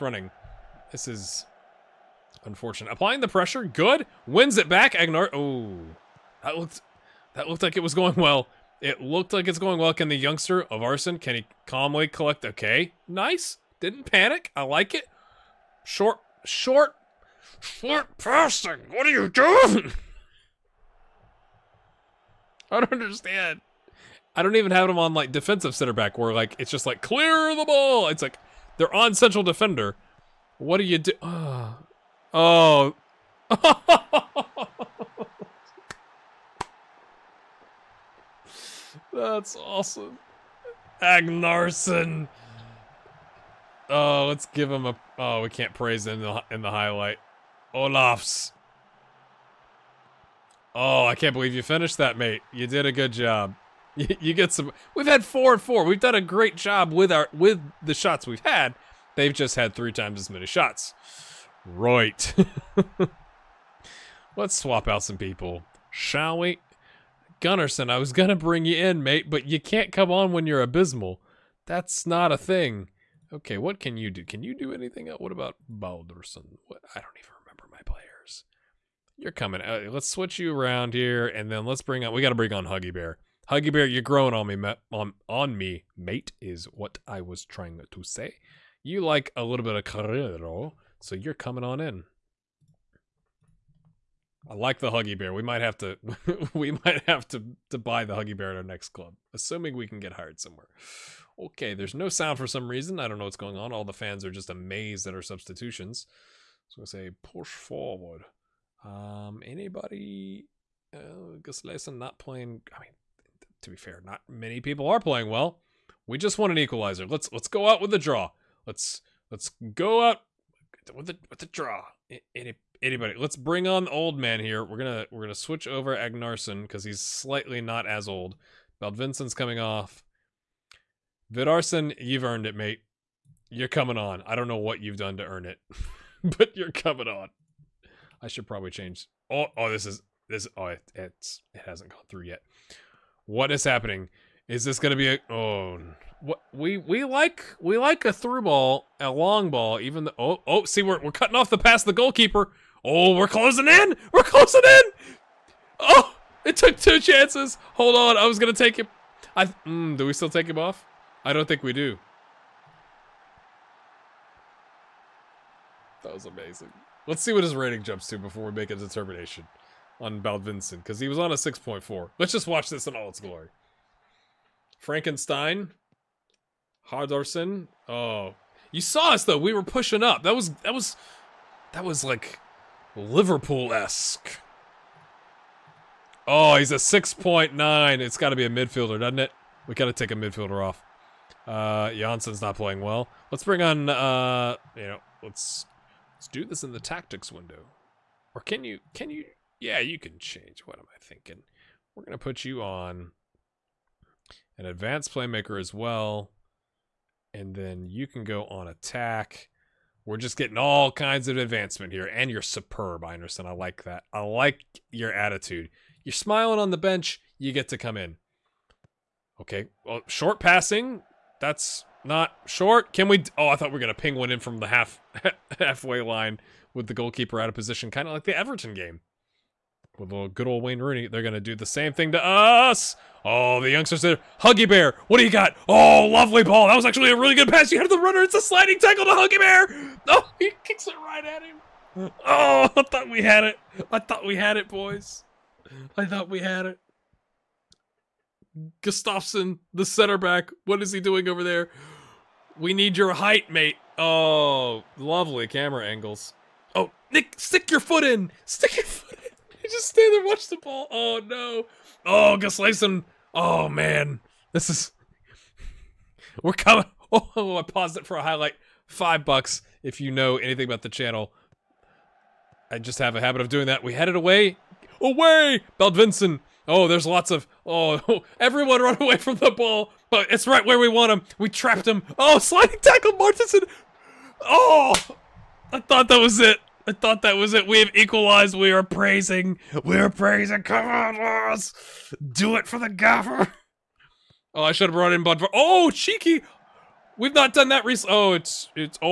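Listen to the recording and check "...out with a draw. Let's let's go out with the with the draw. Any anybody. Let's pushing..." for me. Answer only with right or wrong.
wrong.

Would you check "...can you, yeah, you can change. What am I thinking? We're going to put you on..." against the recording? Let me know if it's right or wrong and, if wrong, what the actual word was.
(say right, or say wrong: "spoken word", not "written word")
right.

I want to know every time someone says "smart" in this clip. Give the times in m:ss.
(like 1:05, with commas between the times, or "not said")
not said.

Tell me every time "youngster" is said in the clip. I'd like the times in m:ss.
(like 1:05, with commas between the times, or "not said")
0:10, 3:53.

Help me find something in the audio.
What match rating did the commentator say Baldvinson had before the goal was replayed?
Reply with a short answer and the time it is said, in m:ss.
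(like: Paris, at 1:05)
6.4, at 2:51.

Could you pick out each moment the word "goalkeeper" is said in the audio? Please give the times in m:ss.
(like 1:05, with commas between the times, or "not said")
2:31, 3:46.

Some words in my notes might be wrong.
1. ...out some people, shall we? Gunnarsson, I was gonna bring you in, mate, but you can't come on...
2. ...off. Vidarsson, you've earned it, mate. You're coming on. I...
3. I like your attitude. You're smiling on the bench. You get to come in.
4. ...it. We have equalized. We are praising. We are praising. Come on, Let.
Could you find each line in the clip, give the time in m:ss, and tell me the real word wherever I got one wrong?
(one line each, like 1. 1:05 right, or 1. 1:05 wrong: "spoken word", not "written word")
1. 1:04 right
2. 2:09 right
3. 3:34 right
4. 4:47 wrong: "Lars", not "Let".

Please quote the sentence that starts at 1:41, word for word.
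Okay, there's no sound for some reason.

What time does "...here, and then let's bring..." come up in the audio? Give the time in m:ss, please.
1:20.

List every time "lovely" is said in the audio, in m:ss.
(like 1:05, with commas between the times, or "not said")
3:56, 4:14.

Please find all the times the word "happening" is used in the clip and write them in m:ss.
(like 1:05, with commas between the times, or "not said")
2:23.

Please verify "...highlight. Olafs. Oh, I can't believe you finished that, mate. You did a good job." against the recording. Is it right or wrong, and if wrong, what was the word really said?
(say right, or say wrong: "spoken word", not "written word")
right.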